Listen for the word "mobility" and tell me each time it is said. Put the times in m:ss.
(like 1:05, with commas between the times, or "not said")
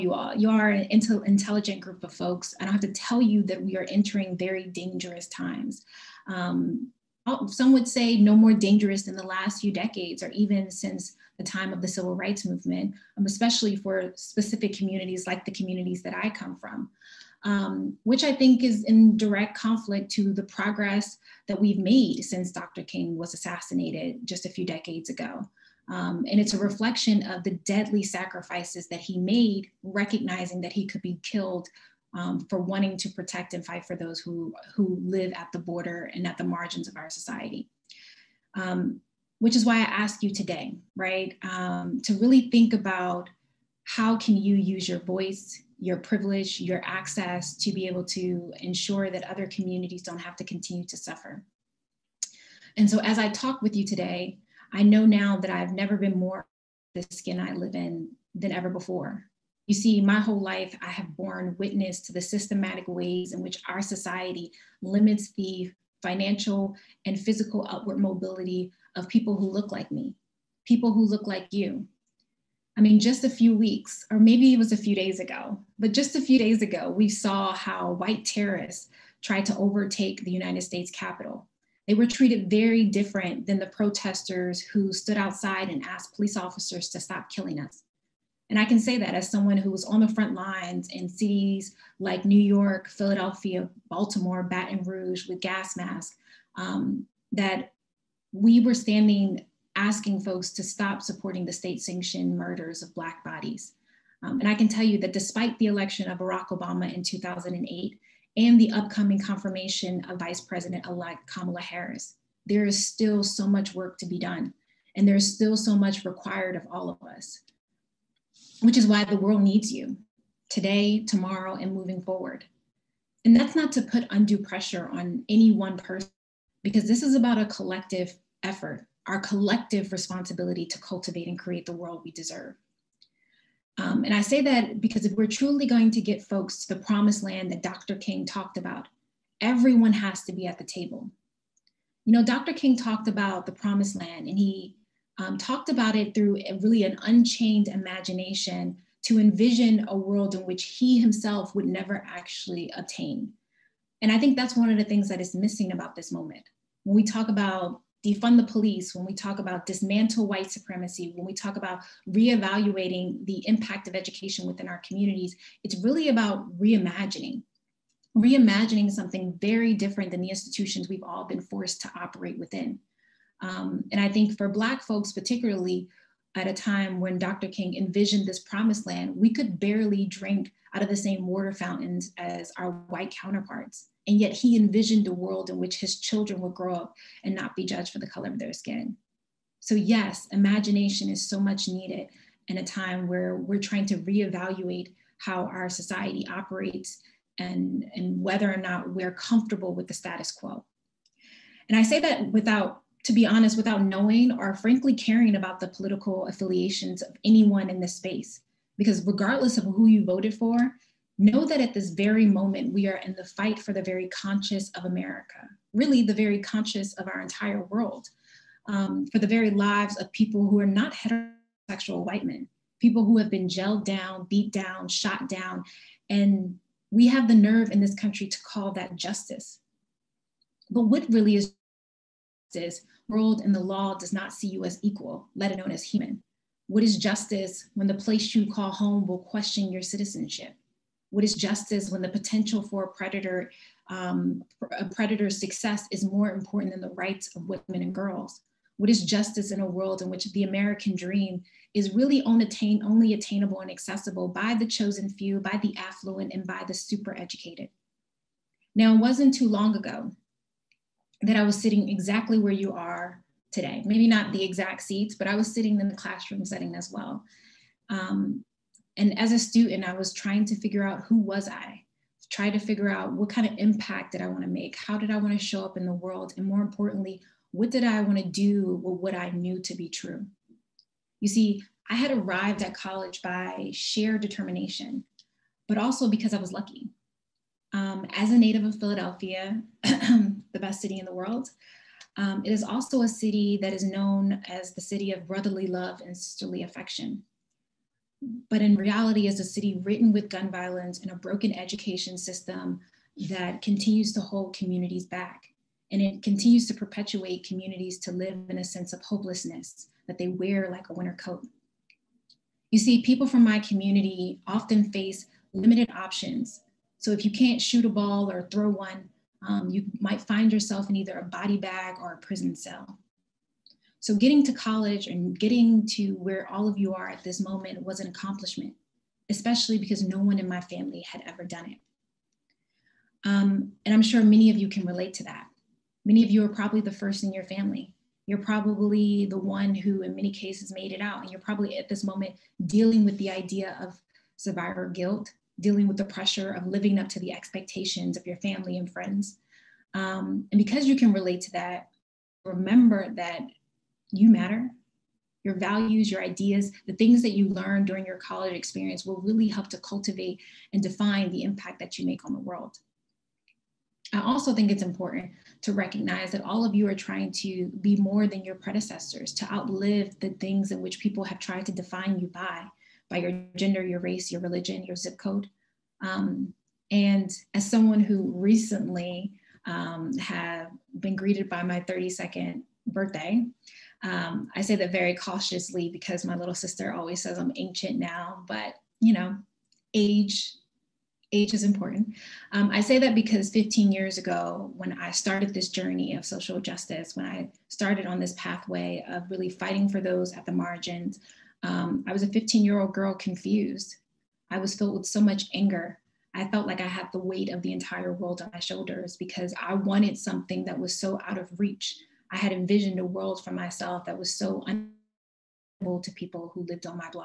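1:07.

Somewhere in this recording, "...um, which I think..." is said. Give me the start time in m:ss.
0:17.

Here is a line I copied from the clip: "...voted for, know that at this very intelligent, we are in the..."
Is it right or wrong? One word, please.
wrong.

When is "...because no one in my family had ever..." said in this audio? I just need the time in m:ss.
5:29.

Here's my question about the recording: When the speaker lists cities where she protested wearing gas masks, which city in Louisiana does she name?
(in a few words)
Baton Rouge.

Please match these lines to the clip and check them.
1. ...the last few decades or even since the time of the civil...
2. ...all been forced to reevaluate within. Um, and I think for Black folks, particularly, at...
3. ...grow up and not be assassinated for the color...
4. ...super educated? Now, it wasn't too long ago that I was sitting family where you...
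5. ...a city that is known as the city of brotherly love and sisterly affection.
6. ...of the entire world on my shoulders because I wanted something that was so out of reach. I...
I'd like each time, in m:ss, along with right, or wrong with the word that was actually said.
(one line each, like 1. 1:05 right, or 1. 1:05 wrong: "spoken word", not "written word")
1. 0:09 right
2. 2:51 wrong: "operate", not "reevaluate"
3. 3:06 wrong: "judged", not "assassinated"
4. 4:16 wrong: "exactly", not "family"
5. 4:53 right
6. 6:47 right.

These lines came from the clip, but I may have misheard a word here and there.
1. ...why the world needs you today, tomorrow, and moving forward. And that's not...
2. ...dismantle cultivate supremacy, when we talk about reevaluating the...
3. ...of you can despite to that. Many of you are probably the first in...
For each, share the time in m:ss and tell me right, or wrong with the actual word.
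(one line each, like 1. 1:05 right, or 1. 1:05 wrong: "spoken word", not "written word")
1. 1:58 right
2. 2:39 wrong: "white", not "cultivate"
3. 5:34 wrong: "relate", not "despite".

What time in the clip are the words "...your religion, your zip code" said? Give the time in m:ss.
6:14.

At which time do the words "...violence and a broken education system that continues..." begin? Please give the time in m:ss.
5:00.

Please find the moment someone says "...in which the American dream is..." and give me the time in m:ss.
4:10.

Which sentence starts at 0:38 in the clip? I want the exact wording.
Um, which is why I ask you today, right?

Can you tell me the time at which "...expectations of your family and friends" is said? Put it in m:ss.
5:47.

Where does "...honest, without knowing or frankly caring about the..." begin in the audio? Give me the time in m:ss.
3:23.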